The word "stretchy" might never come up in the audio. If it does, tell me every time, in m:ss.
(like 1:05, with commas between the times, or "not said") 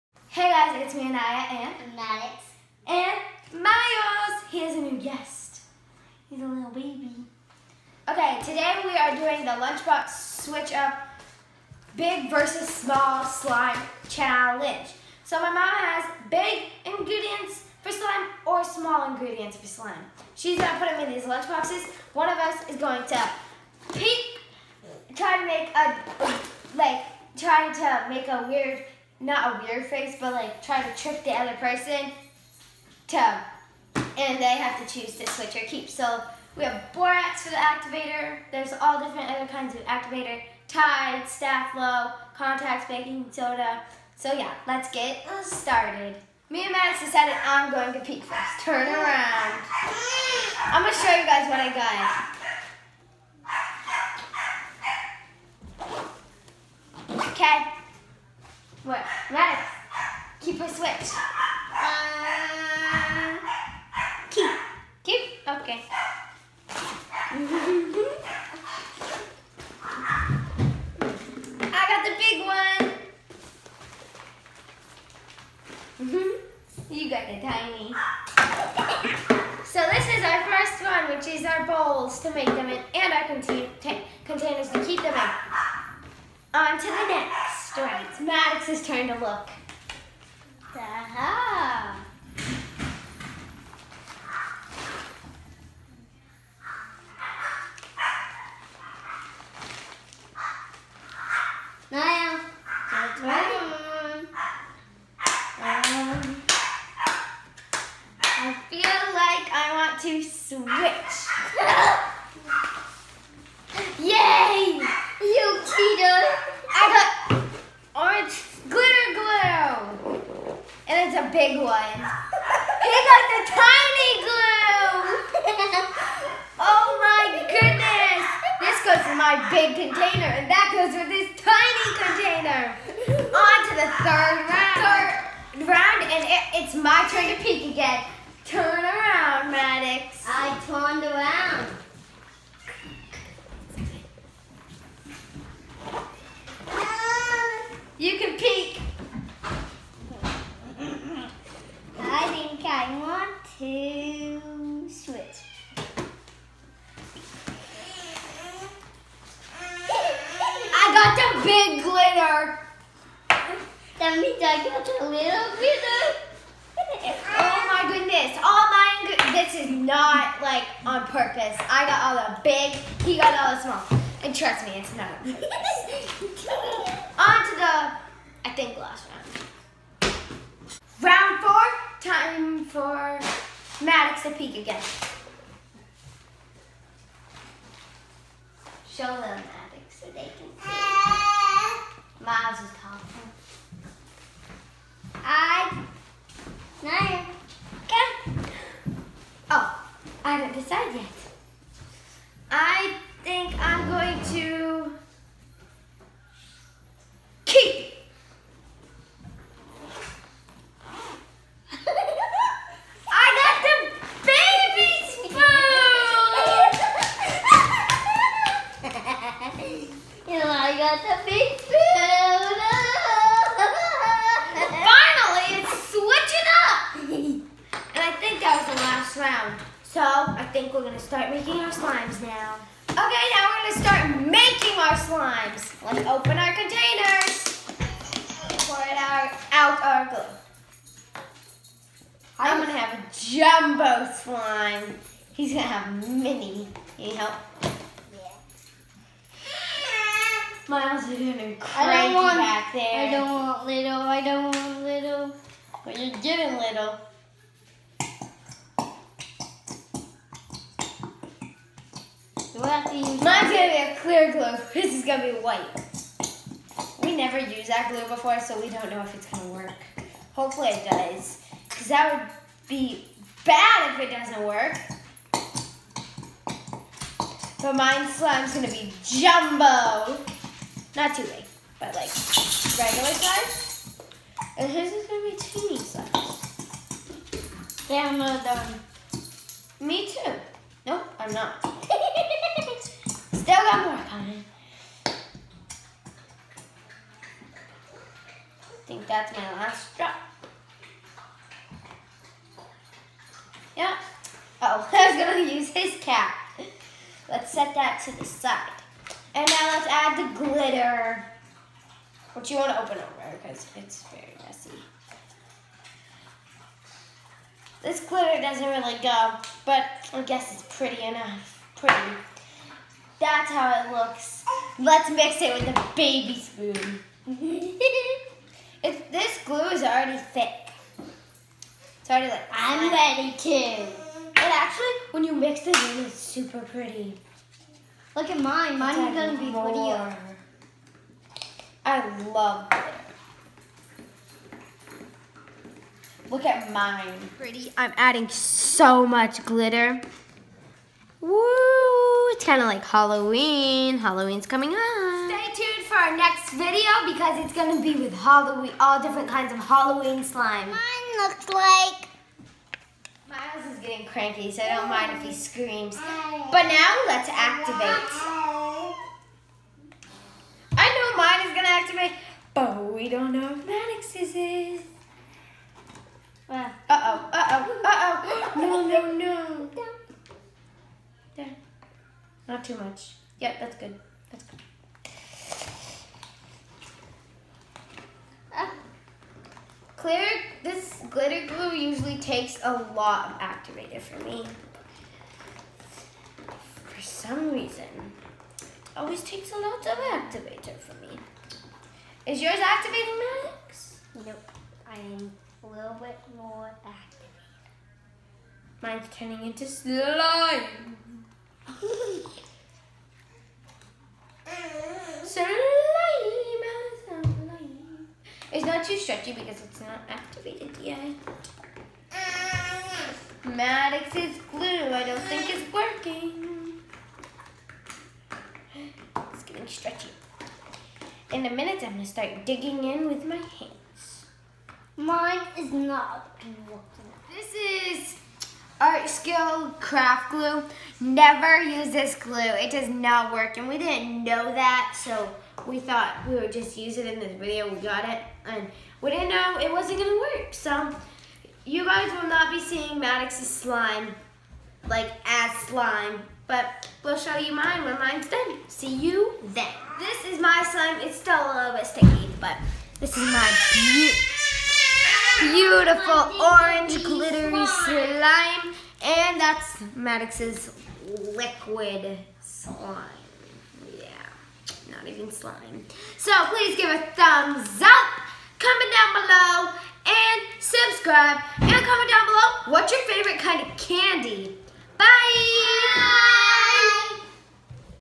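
6:59, 7:09.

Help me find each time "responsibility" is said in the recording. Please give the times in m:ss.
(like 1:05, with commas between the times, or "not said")
not said.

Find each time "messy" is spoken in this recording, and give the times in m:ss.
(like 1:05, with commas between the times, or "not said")
5:14.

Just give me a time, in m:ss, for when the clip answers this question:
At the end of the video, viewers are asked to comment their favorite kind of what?
8:03.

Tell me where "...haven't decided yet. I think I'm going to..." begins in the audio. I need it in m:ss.
3:20.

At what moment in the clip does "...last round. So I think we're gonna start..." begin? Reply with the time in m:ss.
3:49.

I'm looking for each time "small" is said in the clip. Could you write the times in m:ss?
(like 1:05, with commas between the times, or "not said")
0:12, 0:18, 2:53.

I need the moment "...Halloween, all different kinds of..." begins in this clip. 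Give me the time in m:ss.
5:58.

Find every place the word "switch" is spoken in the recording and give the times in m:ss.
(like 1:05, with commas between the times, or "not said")
0:10, 0:35, 1:00, 1:50.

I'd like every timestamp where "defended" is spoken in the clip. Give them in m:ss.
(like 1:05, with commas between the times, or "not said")
not said.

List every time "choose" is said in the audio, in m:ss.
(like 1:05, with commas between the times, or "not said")
0:34.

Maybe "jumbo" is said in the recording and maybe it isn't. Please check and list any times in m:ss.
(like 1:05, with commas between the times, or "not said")
4:03, 4:39.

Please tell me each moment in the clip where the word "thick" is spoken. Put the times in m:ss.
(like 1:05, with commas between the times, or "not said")
5:30.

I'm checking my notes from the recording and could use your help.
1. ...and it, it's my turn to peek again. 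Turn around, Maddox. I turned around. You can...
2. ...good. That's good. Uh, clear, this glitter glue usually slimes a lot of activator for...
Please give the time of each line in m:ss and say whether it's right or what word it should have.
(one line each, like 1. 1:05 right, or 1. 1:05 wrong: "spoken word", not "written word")
1. 2:16 right
2. 6:23 wrong: "takes", not "slimes".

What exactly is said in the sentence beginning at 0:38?
There's all different other kinds of activator.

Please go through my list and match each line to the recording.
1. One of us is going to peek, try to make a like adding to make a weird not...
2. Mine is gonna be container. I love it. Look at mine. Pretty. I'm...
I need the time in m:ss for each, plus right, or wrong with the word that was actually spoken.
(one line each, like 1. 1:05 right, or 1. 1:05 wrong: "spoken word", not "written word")
1. 0:22 wrong: "trying", not "adding"
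2. 5:38 wrong: "prettier", not "container".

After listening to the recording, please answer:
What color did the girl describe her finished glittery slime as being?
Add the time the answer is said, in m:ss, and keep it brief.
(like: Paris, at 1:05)
Orange, at 7:46.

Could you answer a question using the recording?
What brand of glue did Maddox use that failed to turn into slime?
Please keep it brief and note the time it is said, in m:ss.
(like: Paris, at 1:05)
Art Skill craft glue, at 7:18.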